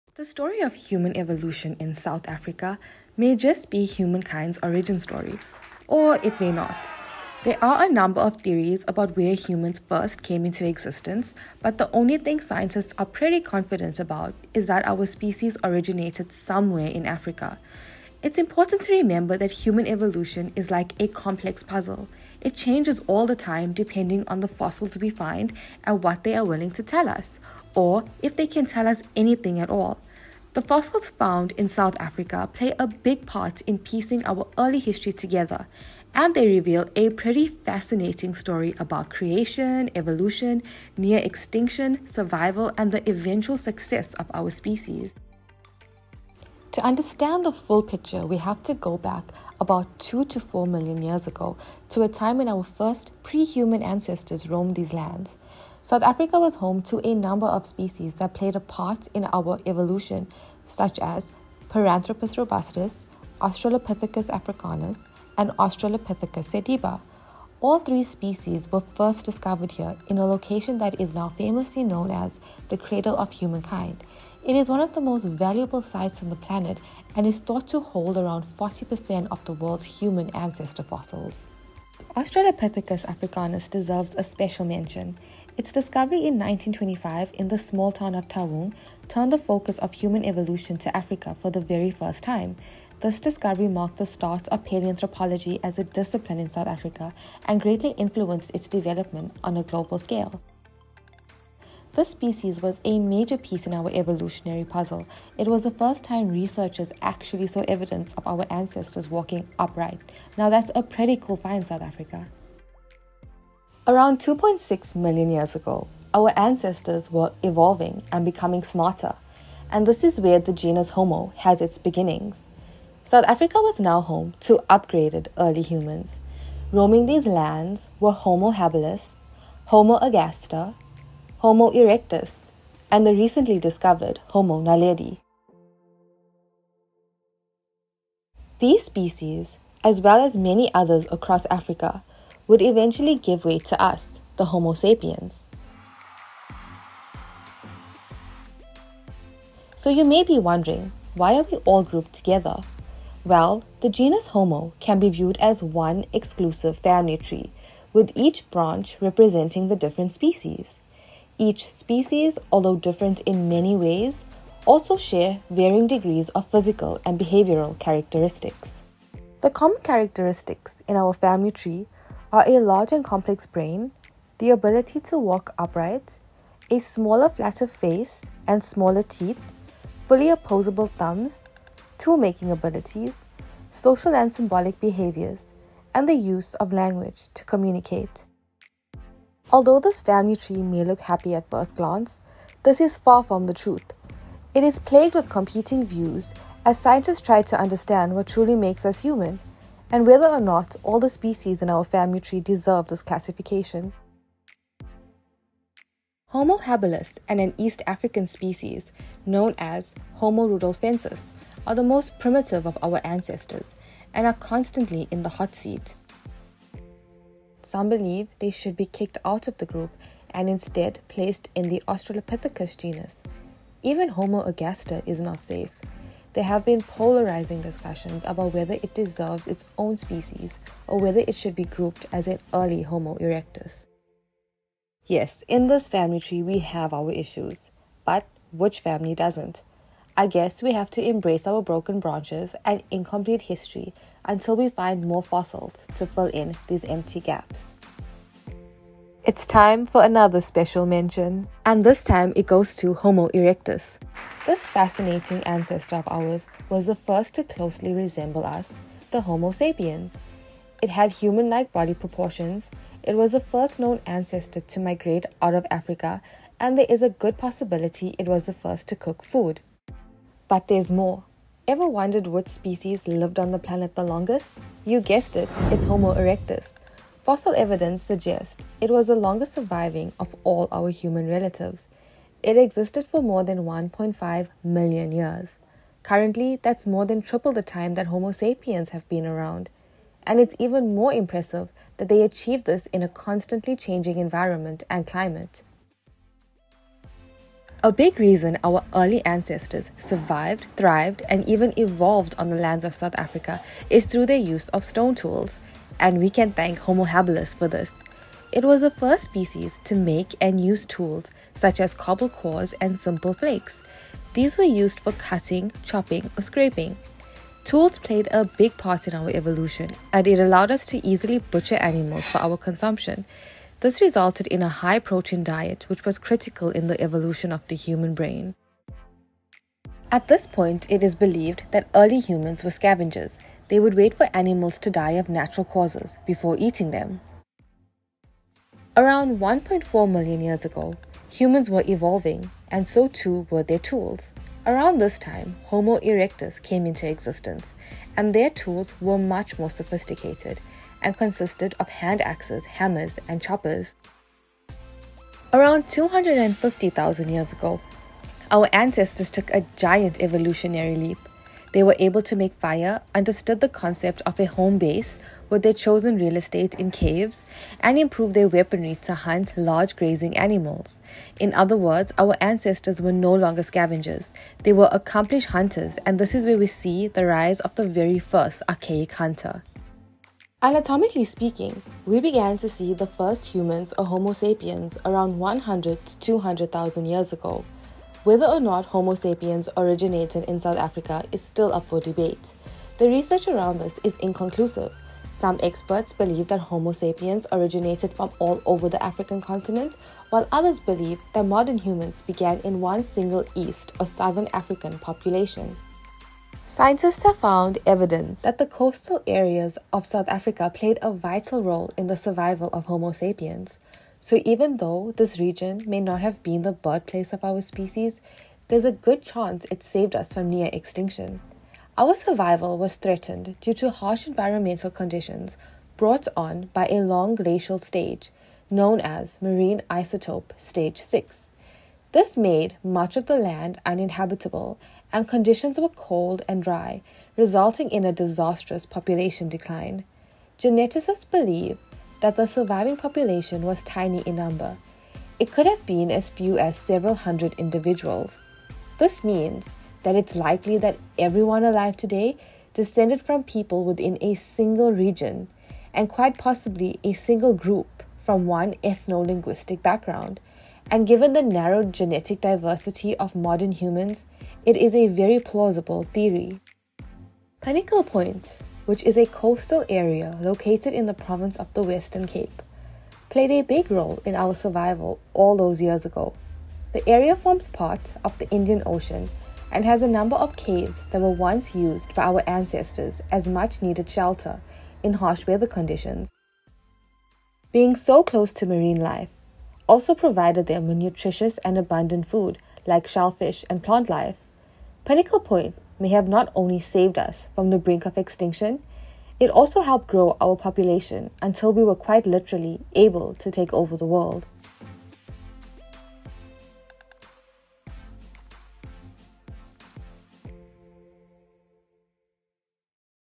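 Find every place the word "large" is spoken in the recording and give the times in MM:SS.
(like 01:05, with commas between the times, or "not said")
02:52, 06:09.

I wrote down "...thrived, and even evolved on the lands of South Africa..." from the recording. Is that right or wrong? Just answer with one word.
right.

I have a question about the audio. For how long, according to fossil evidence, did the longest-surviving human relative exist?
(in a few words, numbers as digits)
More than 1.5 million years.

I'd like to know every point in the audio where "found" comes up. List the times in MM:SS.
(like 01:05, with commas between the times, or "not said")
00:31, 06:47.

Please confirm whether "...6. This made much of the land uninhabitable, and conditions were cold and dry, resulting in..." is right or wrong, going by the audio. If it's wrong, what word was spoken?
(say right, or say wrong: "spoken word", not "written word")
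right.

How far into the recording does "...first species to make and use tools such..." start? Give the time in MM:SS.
05:08.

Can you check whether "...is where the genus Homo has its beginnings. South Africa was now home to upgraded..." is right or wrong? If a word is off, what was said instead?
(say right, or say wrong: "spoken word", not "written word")
right.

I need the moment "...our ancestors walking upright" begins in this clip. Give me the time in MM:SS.
01:48.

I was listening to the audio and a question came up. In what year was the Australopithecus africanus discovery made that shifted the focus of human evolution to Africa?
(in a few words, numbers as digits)
1925.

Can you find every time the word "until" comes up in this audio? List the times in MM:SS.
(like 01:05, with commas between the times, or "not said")
04:04, 08:21.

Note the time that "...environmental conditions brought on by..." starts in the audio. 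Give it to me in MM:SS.
07:04.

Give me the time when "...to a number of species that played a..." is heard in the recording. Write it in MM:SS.
00:56.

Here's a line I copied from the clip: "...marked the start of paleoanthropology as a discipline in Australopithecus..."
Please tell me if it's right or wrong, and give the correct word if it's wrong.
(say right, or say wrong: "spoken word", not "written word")
wrong: "South", not "Australopithecus".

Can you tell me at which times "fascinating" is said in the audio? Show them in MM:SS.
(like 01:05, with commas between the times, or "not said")
00:37, 04:14.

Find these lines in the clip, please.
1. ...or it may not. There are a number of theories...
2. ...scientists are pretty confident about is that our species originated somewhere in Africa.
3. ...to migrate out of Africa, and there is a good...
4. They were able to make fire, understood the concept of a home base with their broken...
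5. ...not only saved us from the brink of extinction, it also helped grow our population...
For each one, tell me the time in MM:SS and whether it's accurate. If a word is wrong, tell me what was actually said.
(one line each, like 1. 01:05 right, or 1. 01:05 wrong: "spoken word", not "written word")
1. 00:05 right
2. 00:12 right
3. 04:24 right
4. 06:01 wrong: "chosen", not "broken"
5. 08:16 right.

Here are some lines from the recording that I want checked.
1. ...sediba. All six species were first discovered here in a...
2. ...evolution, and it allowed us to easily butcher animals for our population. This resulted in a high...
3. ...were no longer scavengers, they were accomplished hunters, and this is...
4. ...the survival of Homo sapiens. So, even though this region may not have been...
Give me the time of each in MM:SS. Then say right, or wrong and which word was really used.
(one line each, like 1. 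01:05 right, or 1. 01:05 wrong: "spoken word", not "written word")
1. 01:06 wrong: "three", not "six"
2. 05:19 wrong: "consumption", not "population"
3. 06:13 right
4. 06:52 right.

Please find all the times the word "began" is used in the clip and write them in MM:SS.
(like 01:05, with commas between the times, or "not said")
06:22, 06:42.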